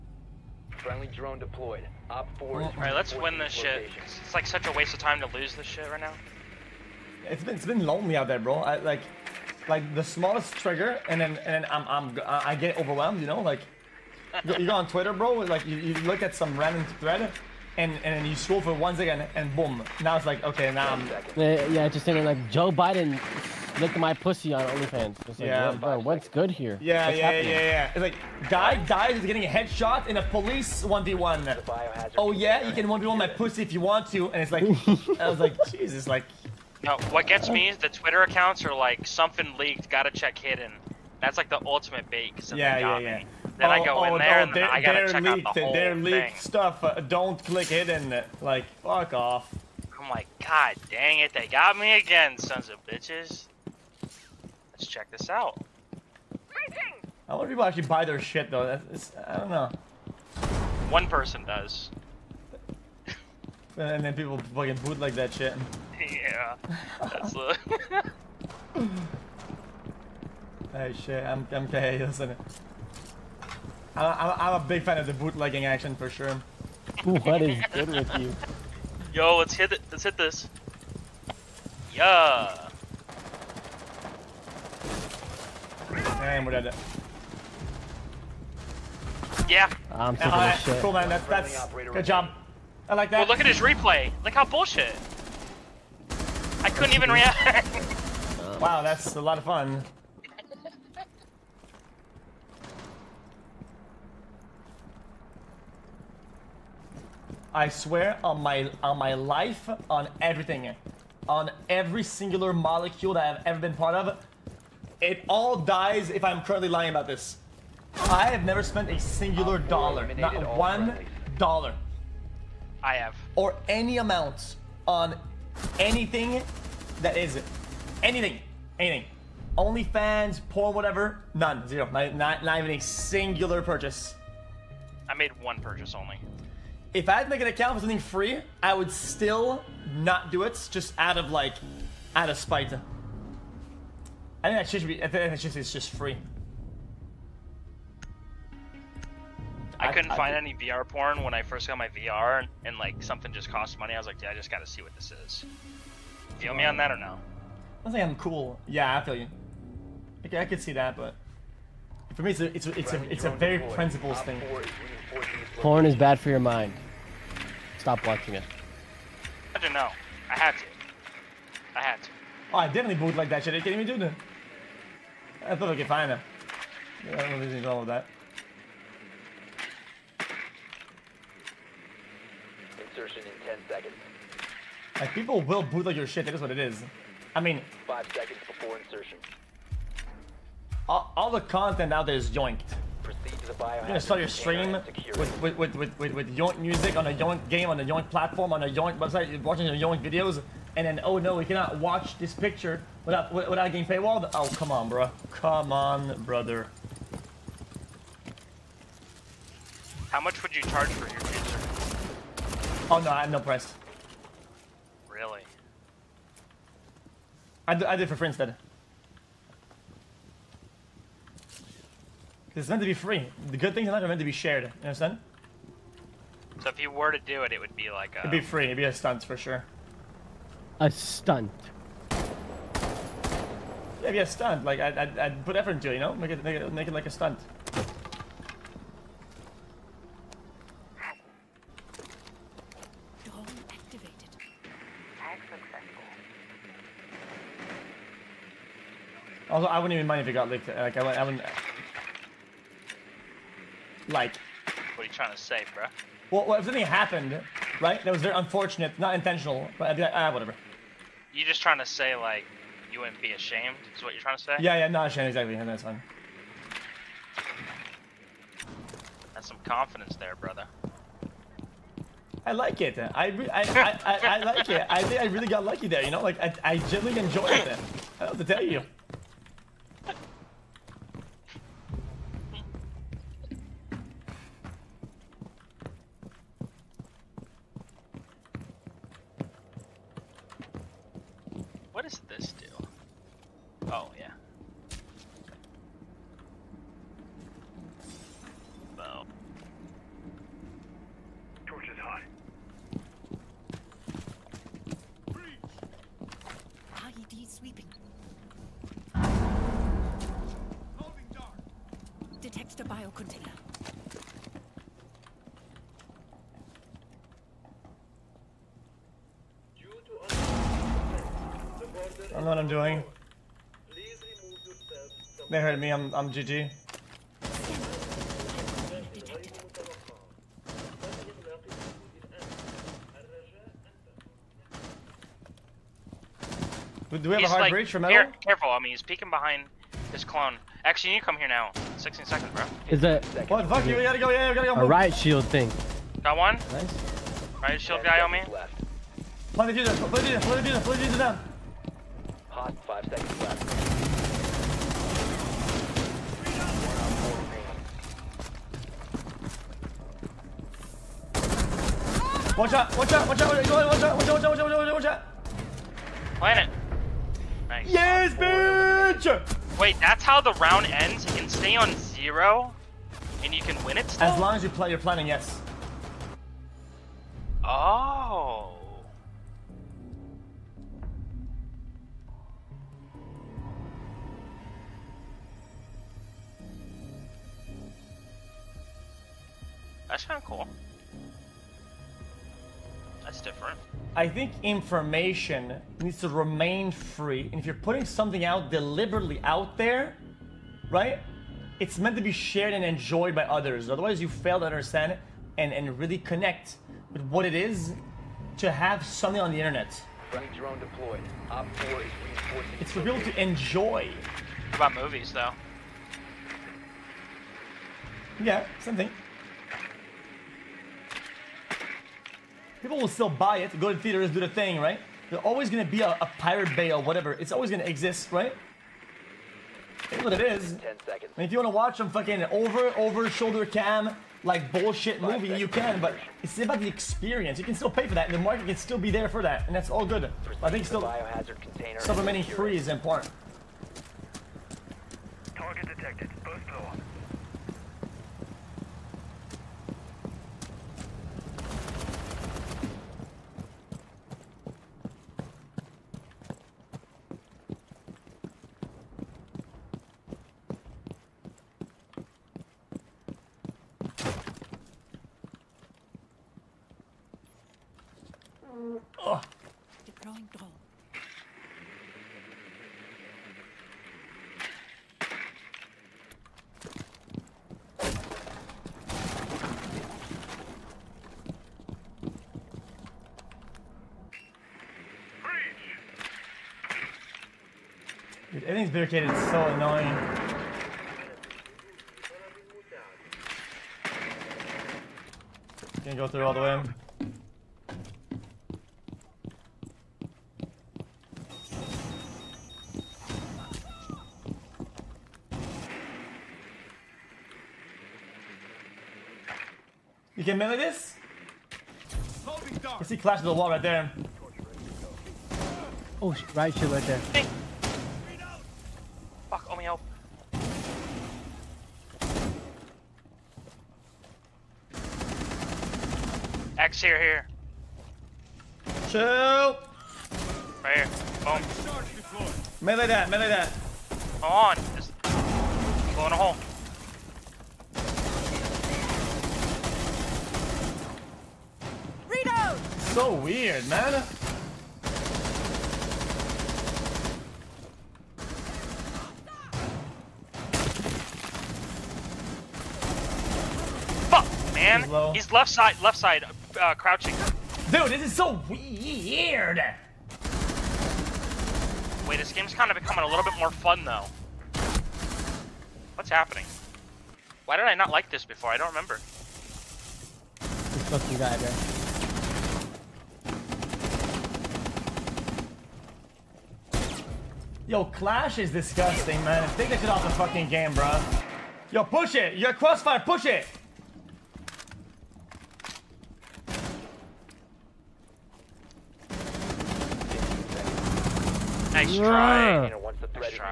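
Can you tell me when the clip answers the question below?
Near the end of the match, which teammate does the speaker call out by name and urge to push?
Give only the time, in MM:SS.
09:42.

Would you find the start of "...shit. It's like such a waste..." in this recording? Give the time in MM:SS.
00:03.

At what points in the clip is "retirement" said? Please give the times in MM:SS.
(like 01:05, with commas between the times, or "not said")
not said.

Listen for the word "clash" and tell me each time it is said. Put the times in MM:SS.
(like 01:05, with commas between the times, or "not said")
08:33, 09:38.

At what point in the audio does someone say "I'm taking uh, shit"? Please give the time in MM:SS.
01:29.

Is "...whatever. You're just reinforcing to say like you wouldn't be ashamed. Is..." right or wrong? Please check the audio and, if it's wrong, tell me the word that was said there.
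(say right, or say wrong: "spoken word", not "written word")
wrong: "trying", not "reinforcing".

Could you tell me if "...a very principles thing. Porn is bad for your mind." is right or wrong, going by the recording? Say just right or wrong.
right.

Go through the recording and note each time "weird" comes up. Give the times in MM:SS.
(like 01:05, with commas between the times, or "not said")
09:03, 09:18.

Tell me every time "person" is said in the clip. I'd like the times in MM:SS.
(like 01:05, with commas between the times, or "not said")
01:01.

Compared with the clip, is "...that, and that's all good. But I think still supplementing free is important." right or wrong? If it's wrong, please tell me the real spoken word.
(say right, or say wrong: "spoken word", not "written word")
right.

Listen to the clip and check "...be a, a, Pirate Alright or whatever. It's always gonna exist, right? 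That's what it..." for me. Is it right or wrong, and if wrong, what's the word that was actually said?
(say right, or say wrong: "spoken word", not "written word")
wrong: "Bay", not "Alright".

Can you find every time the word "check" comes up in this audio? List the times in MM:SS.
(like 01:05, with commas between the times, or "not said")
00:40, 00:45, 00:54.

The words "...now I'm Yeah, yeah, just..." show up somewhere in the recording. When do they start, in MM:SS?
00:20.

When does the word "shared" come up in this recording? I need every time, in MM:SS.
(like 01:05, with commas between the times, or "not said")
03:44, 06:42.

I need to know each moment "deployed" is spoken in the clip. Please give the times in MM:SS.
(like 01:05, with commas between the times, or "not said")
00:01, 06:50.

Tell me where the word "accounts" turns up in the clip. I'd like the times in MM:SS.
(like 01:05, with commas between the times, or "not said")
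00:38, 02:17.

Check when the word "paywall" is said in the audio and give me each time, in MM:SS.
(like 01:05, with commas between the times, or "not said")
03:23.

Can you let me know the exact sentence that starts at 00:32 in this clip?
Oh, yeah, you can 1v1 my pussy if you want to.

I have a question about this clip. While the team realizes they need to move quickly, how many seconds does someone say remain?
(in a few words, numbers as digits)
16.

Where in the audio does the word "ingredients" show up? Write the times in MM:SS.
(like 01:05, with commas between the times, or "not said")
not said.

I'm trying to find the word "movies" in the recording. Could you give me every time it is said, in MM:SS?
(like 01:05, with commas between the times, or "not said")
06:54, 07:15.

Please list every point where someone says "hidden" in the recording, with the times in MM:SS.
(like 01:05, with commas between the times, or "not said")
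00:40, 00:47.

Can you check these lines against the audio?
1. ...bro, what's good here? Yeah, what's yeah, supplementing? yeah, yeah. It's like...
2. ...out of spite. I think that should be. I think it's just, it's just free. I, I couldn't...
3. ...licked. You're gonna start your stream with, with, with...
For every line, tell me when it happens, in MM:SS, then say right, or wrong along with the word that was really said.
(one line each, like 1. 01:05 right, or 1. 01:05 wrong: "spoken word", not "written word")
1. 00:25 wrong: "happening", not "supplementing"
2. 02:22 right
3. 03:12 wrong: "yoinked", not "licked".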